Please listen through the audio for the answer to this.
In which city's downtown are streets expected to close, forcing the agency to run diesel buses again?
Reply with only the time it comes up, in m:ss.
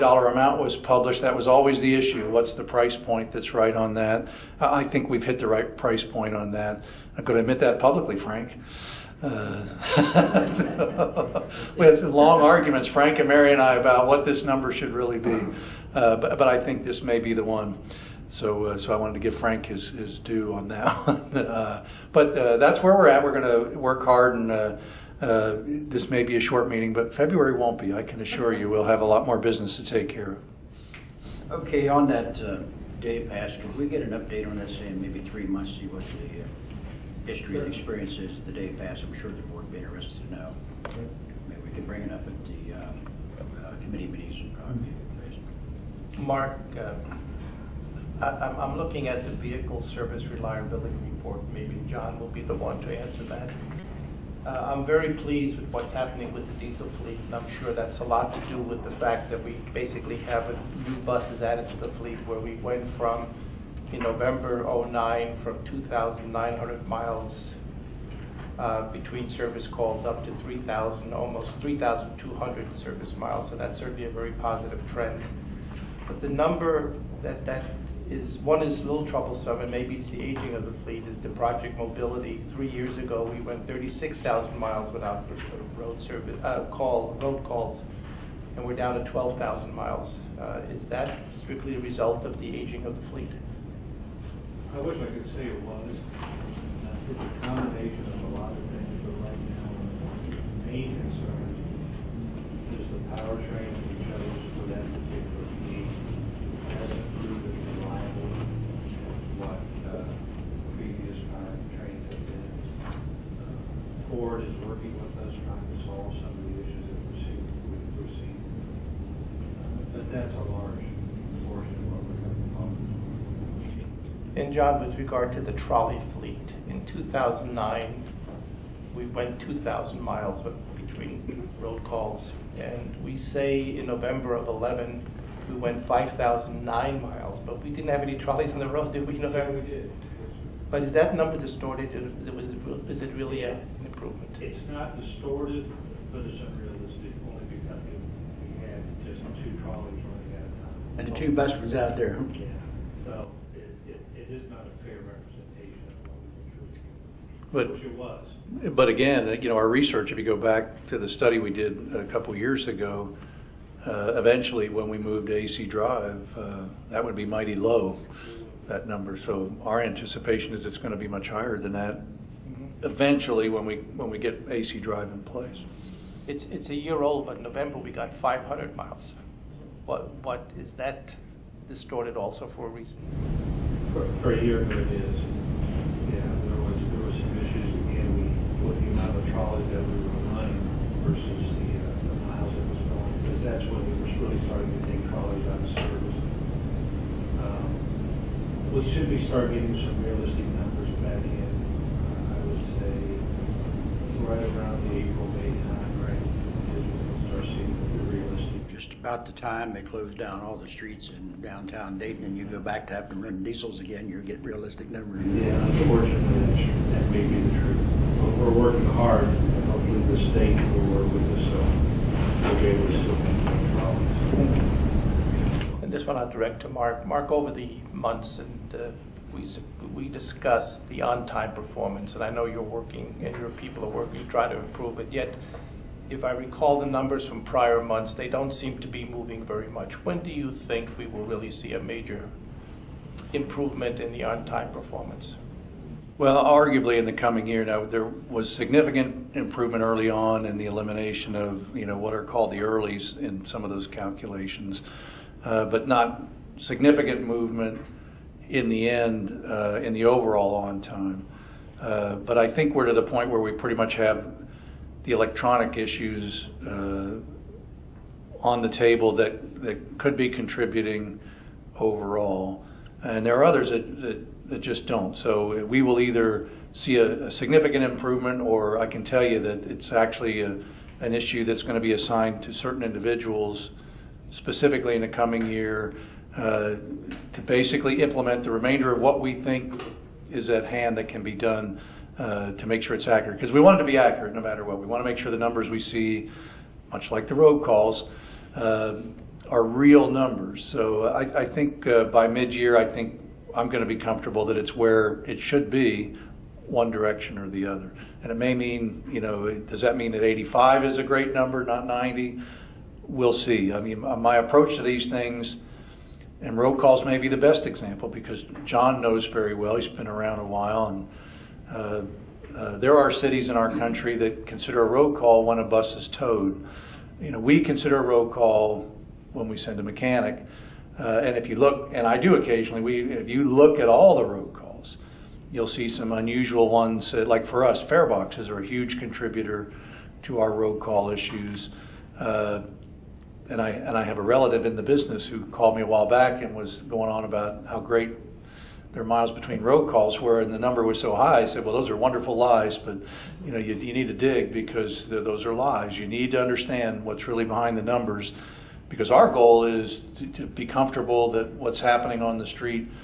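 3:31.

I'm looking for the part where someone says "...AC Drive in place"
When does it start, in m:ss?
2:54.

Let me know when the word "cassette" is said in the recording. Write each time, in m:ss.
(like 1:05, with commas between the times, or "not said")
not said.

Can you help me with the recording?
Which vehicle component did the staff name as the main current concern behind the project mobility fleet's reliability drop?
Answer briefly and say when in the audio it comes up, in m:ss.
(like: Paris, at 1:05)
powertrain, at 1:43.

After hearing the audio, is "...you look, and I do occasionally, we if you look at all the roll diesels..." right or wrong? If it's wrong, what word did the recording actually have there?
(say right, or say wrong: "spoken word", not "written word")
wrong: "calls", not "diesels".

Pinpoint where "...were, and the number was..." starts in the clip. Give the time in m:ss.
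5:50.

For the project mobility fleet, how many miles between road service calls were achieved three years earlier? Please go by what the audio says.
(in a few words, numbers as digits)
36,000.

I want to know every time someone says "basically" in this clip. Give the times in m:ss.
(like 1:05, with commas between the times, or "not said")
0:59, 4:47.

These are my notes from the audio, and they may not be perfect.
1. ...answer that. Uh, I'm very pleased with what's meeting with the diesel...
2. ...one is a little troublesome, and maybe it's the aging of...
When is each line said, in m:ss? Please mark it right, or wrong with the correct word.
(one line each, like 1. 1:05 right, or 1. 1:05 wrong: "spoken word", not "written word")
1. 0:52 wrong: "happening", not "meeting"
2. 1:18 right.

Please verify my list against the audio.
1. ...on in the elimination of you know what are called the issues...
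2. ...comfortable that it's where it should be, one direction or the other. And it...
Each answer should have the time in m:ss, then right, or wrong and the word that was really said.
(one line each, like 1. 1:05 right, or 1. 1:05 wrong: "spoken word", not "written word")
1. 4:10 wrong: "earlies", not "issues"
2. 5:03 right.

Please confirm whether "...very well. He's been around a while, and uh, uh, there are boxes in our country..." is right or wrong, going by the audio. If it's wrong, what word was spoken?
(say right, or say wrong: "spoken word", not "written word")
wrong: "cities", not "boxes".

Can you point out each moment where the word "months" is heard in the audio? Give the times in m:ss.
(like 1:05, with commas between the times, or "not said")
0:35, 3:47, 3:57.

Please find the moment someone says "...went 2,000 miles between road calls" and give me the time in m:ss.
2:09.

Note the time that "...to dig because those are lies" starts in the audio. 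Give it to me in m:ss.
5:54.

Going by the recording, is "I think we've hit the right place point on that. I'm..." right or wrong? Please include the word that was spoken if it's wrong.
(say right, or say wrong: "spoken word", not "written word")
wrong: "price", not "place".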